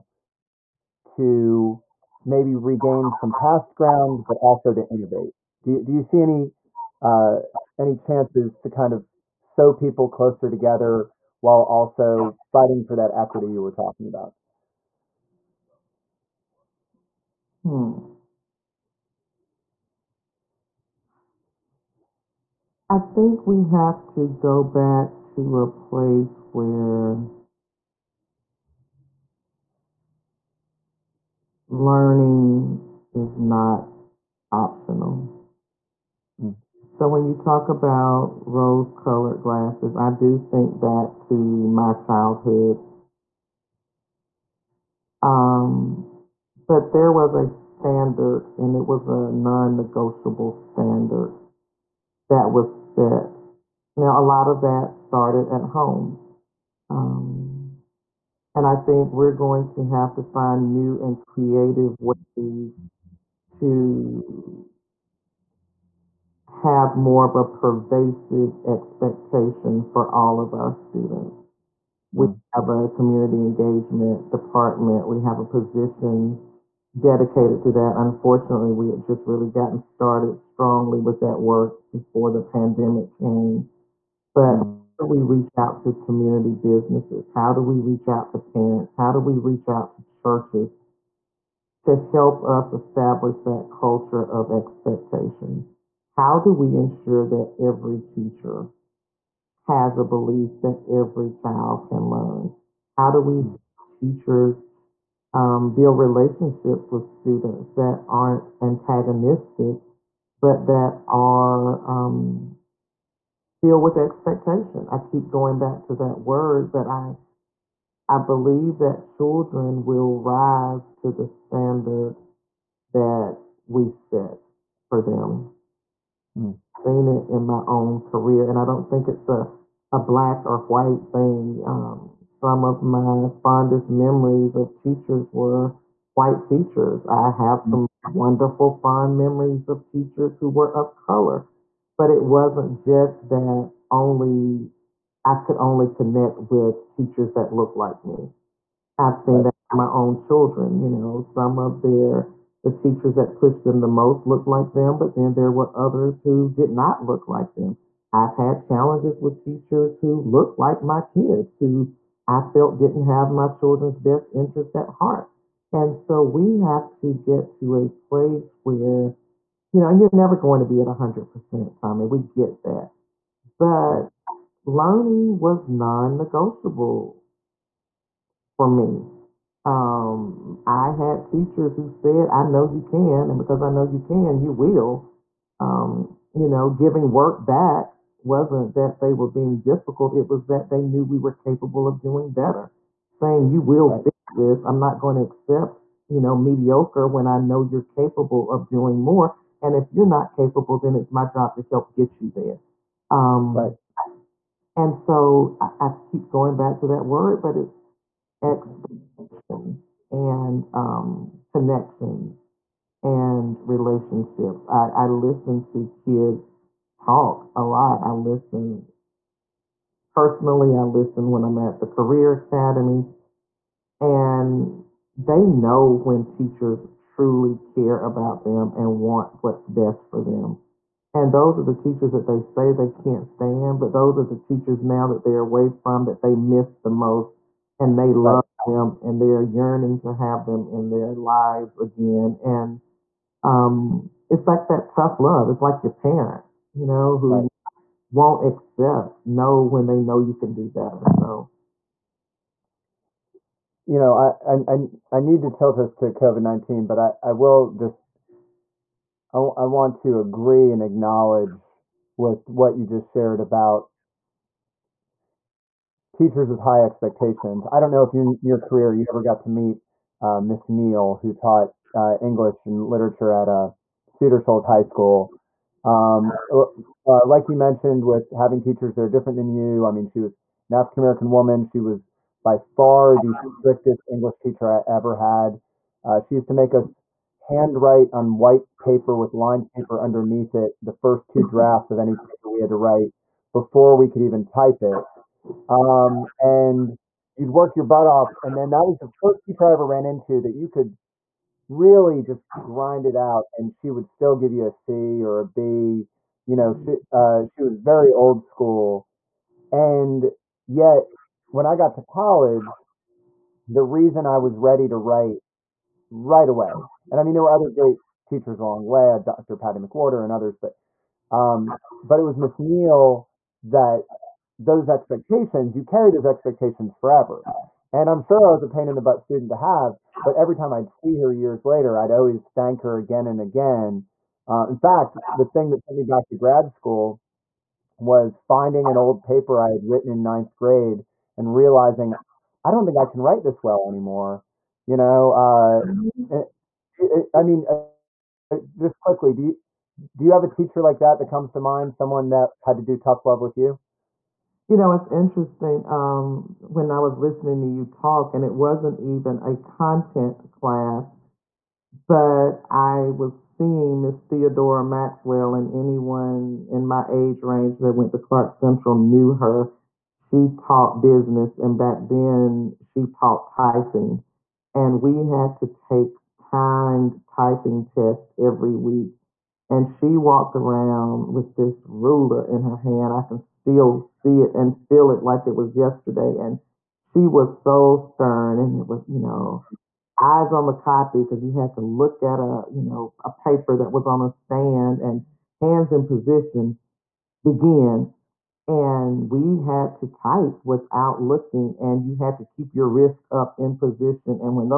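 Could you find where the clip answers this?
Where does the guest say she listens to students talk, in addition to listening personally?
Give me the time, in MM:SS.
03:41.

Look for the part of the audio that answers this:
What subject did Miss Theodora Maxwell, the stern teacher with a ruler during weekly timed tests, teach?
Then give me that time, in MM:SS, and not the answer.
06:11.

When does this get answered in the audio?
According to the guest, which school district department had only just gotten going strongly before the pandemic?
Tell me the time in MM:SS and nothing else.
01:12.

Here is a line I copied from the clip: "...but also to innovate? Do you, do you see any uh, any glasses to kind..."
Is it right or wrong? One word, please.
wrong.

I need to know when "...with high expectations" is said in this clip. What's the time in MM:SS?
04:26.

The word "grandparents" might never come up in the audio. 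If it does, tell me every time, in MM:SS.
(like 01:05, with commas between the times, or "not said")
not said.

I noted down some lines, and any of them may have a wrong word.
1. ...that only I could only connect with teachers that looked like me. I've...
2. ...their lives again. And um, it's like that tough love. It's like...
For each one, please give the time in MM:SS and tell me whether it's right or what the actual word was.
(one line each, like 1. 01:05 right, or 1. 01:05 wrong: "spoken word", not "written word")
1. 02:23 right
2. 04:00 right.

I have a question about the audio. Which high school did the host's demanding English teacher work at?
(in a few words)
Cedar Shoals High School.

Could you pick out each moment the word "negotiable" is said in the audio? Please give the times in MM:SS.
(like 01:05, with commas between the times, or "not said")
00:49, 02:56.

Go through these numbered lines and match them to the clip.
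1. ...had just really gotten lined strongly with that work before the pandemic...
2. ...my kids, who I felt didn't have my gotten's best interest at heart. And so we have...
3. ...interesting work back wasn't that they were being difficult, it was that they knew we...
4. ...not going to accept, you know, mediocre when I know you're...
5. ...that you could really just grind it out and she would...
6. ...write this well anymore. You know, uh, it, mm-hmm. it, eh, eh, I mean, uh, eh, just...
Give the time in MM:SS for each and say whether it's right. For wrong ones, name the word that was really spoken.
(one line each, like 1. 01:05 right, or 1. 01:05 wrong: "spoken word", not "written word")
1. 01:18 wrong: "started", not "lined"
2. 02:40 wrong: "children", not "gotten"
3. 03:06 wrong: "giving", not "interesting"
4. 03:14 right
5. 05:00 right
6. 05:43 right.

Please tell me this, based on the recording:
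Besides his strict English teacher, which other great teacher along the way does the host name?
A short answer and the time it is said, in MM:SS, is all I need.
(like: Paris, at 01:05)
Dr. Patty McWhorter, at 05:19.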